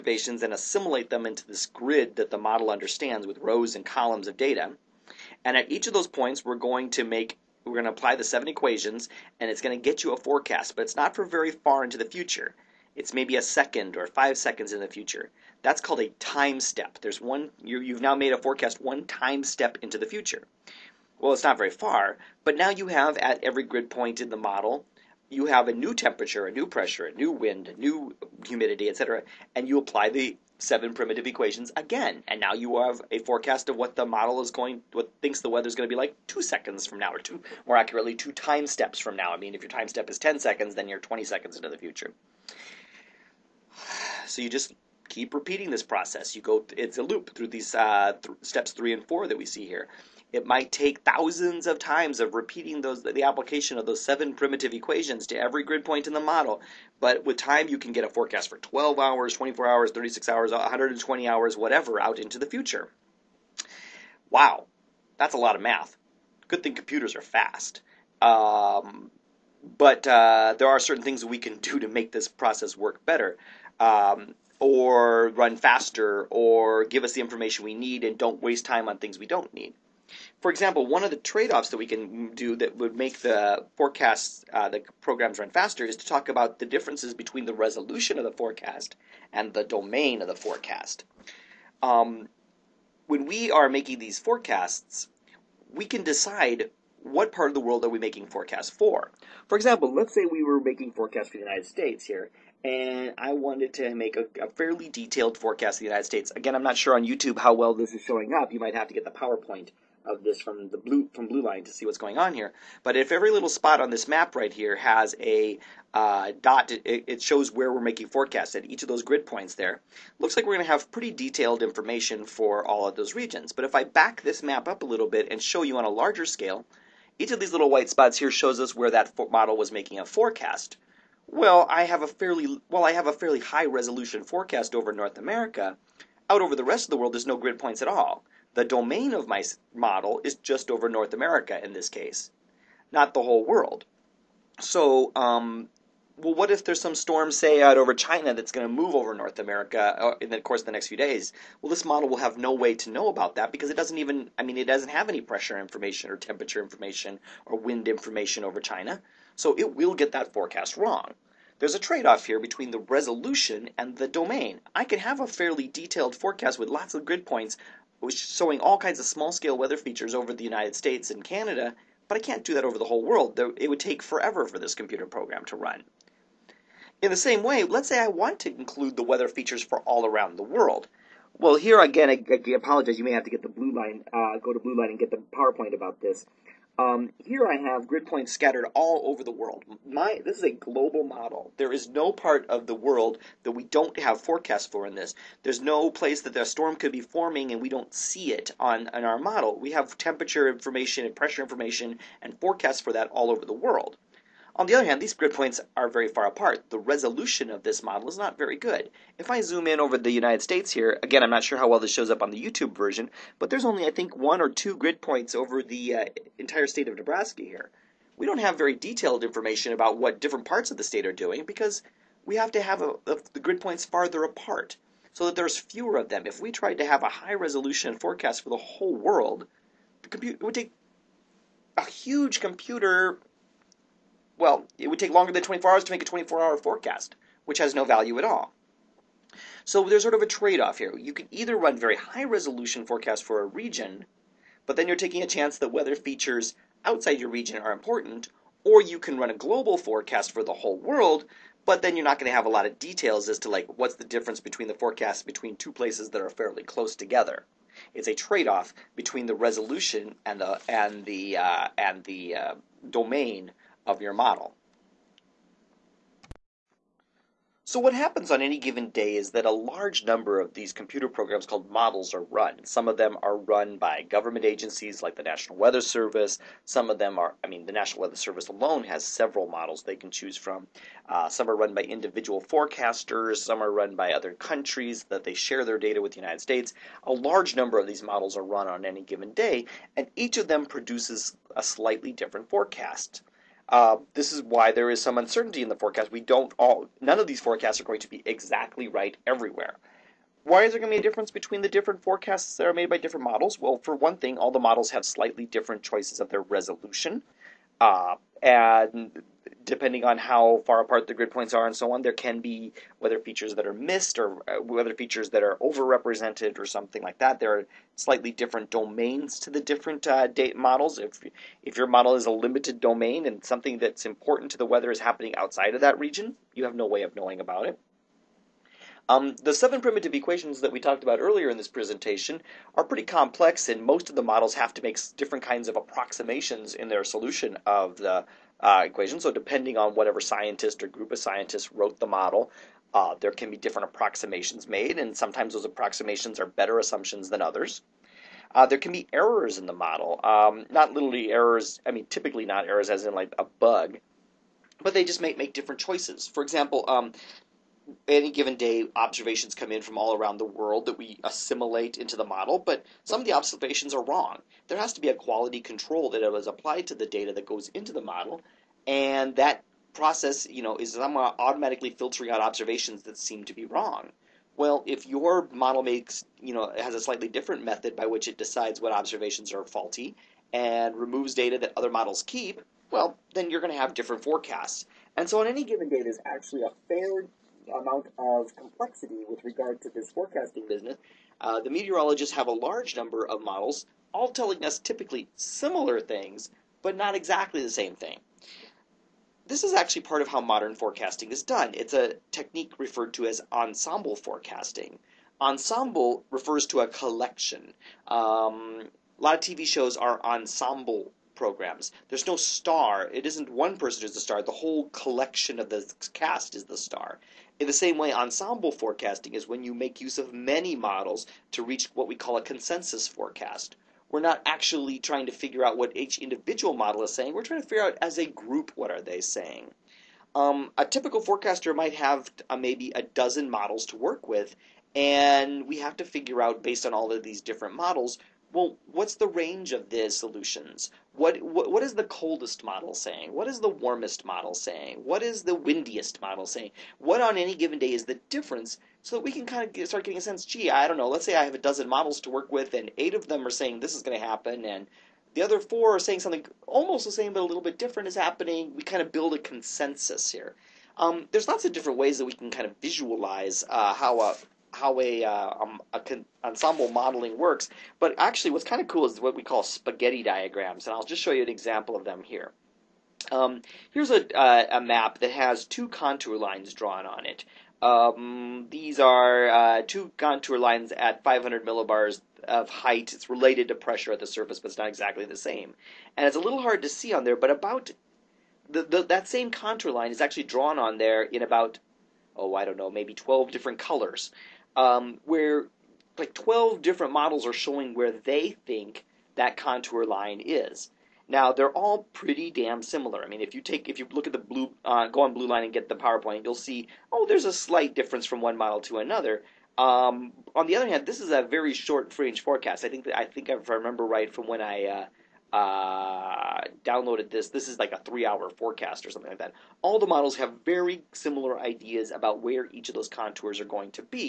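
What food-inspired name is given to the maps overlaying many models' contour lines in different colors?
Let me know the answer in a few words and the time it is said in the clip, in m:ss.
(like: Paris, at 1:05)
Spaghetti diagrams, at 7:49.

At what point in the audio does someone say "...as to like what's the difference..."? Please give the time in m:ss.
4:13.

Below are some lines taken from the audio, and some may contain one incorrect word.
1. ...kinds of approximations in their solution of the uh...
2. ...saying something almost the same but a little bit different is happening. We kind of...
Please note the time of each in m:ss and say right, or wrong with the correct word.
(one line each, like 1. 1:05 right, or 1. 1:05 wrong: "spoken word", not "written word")
1. 5:35 right
2. 7:35 right.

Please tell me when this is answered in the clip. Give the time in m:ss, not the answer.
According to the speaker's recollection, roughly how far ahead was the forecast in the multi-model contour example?
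8:37.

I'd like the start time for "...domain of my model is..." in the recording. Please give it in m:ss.
2:18.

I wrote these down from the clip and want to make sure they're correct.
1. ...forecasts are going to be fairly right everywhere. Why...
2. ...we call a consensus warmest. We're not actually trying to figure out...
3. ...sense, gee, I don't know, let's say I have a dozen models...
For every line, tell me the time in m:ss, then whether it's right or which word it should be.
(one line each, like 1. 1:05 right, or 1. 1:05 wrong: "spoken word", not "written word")
1. 4:57 wrong: "exactly", not "fairly"
2. 7:02 wrong: "forecast", not "warmest"
3. 7:30 right.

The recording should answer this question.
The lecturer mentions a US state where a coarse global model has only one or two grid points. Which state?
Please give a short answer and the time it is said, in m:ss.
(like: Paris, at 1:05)
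Nebraska, at 3:36.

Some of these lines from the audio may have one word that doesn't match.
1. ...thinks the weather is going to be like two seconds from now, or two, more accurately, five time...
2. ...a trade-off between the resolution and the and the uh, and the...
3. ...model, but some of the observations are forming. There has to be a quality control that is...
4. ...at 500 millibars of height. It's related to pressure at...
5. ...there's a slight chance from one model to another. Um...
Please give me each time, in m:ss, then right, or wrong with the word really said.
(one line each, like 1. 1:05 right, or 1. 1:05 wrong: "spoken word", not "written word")
1. 0:35 wrong: "two", not "five"
2. 4:18 right
3. 6:02 wrong: "wrong", not "forming"
4. 8:00 right
5. 8:27 wrong: "difference", not "chance".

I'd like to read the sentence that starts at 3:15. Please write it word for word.
There's no place that a storm could be forming and we don't see it on in our model.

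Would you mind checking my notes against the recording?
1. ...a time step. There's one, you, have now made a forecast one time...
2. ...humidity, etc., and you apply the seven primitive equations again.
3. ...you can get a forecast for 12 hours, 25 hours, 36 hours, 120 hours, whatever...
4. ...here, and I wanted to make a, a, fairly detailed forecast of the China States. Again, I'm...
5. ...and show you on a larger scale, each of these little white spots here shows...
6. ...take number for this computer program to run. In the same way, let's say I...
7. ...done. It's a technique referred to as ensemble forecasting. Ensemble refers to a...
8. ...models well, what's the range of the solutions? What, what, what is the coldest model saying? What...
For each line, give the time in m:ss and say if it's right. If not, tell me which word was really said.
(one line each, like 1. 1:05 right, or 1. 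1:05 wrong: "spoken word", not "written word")
1. 0:15 right
2. 0:28 right
3. 0:57 wrong: "24", not "25"
4. 1:42 wrong: "United", not "China"
5. 2:05 right
6. 2:53 wrong: "forever", not "number"
7. 6:41 right
8. 7:17 right.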